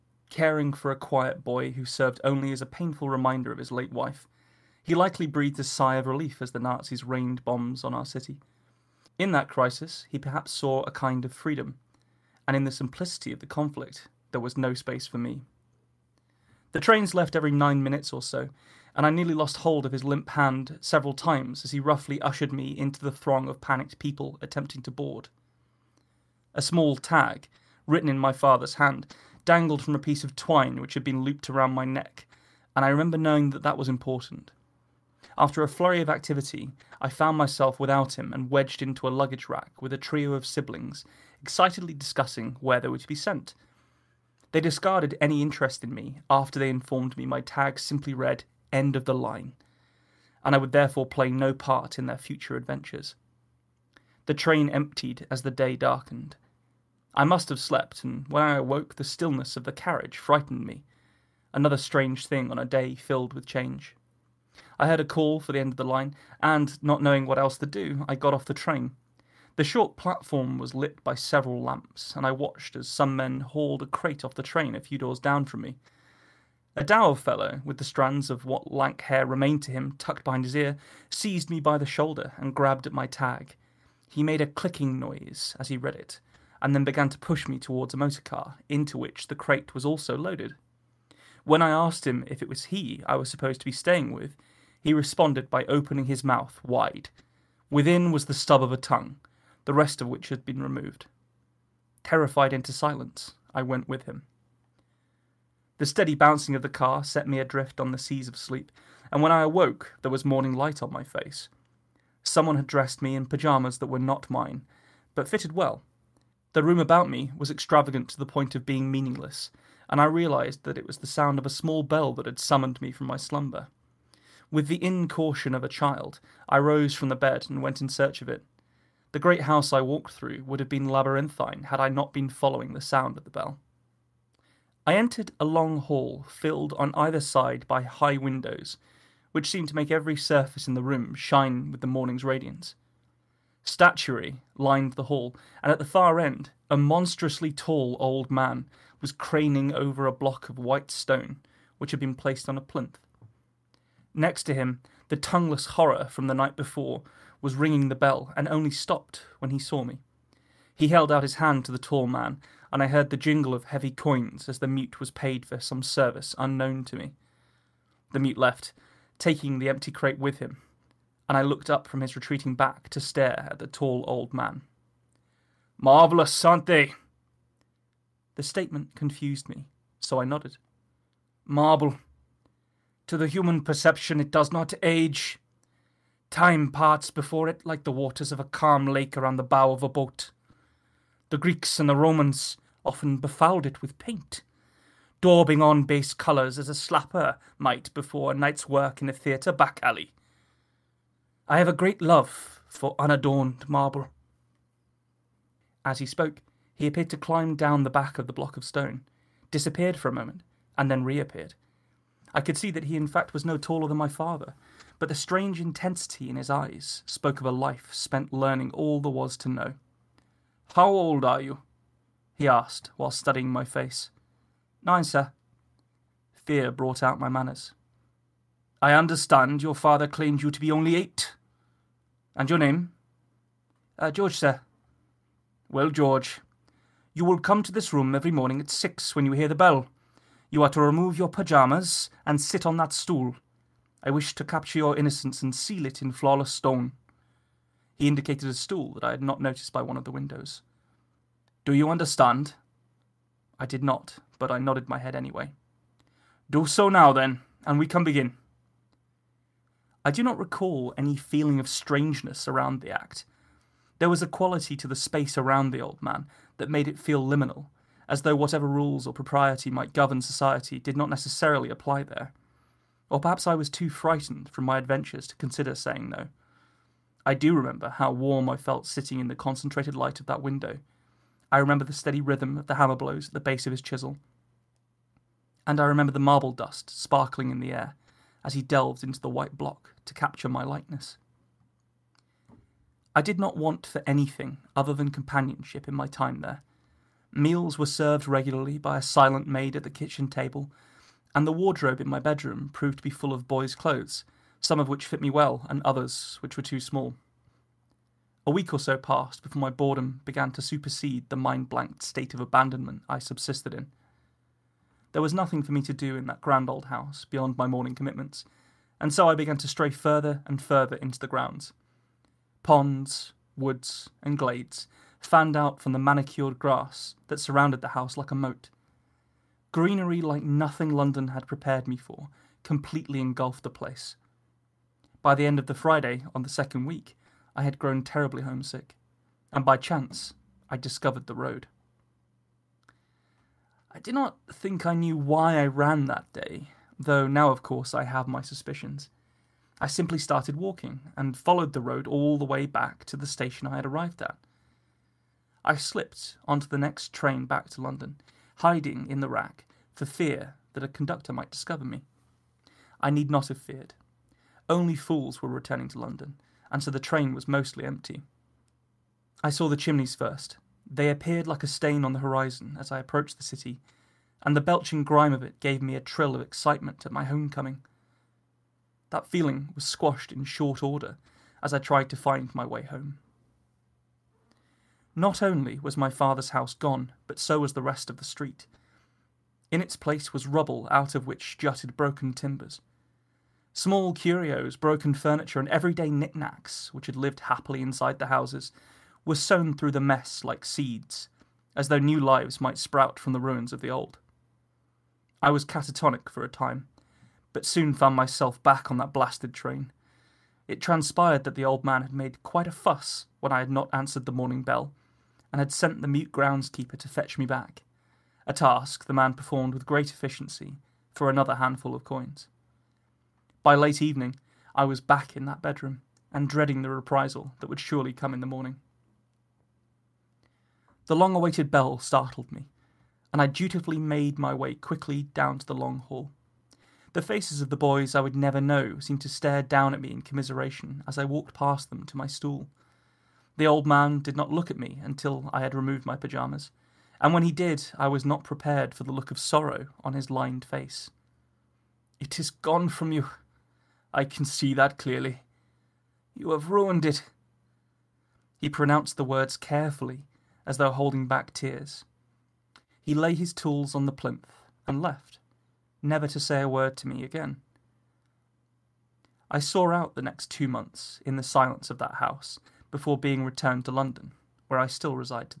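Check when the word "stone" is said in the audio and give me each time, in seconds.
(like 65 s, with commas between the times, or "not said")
150 s, 208 s, 246 s.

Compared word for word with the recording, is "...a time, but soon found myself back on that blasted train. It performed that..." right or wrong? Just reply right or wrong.
wrong.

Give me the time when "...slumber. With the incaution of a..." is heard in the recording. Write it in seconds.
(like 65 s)
123 s.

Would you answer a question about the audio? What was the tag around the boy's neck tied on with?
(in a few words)
twine.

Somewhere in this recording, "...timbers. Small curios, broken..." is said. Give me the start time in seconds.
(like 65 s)
392 s.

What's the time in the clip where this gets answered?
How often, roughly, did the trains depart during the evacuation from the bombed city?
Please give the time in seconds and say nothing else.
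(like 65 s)
17 s.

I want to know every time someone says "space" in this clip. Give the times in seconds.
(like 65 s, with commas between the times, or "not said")
14 s, 264 s.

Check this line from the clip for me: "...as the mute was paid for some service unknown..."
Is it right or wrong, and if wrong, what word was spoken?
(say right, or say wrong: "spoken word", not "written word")
right.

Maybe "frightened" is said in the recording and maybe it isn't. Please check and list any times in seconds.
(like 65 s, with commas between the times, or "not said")
60 s, 273 s.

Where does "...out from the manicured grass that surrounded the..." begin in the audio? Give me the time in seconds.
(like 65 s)
325 s.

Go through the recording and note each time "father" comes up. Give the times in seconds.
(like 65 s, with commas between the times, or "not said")
28 s, 214 s, 229 s, 386 s.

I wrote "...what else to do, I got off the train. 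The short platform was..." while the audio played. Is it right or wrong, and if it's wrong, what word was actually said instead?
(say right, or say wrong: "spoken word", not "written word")
right.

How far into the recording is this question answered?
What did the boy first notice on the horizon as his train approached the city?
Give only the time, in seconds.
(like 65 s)
369 s.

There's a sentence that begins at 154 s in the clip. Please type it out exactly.
Next to him, the tongueless horror from the night before was ringing the bell and only stopped when he saw me.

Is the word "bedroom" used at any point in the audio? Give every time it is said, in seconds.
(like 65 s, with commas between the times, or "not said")
302 s, 425 s.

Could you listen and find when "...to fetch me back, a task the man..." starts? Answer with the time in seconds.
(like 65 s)
416 s.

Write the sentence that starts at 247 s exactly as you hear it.
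He indicated a stool that I had not noticed by one of the windows.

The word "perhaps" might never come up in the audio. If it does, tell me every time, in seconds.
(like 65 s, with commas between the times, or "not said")
10 s, 273 s.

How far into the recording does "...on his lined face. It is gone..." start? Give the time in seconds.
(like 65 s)
450 s.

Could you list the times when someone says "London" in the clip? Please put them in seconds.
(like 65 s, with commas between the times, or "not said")
330 s, 357 s, 365 s, 473 s.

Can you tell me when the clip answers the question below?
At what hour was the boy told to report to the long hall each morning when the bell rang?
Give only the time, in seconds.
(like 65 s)
238 s.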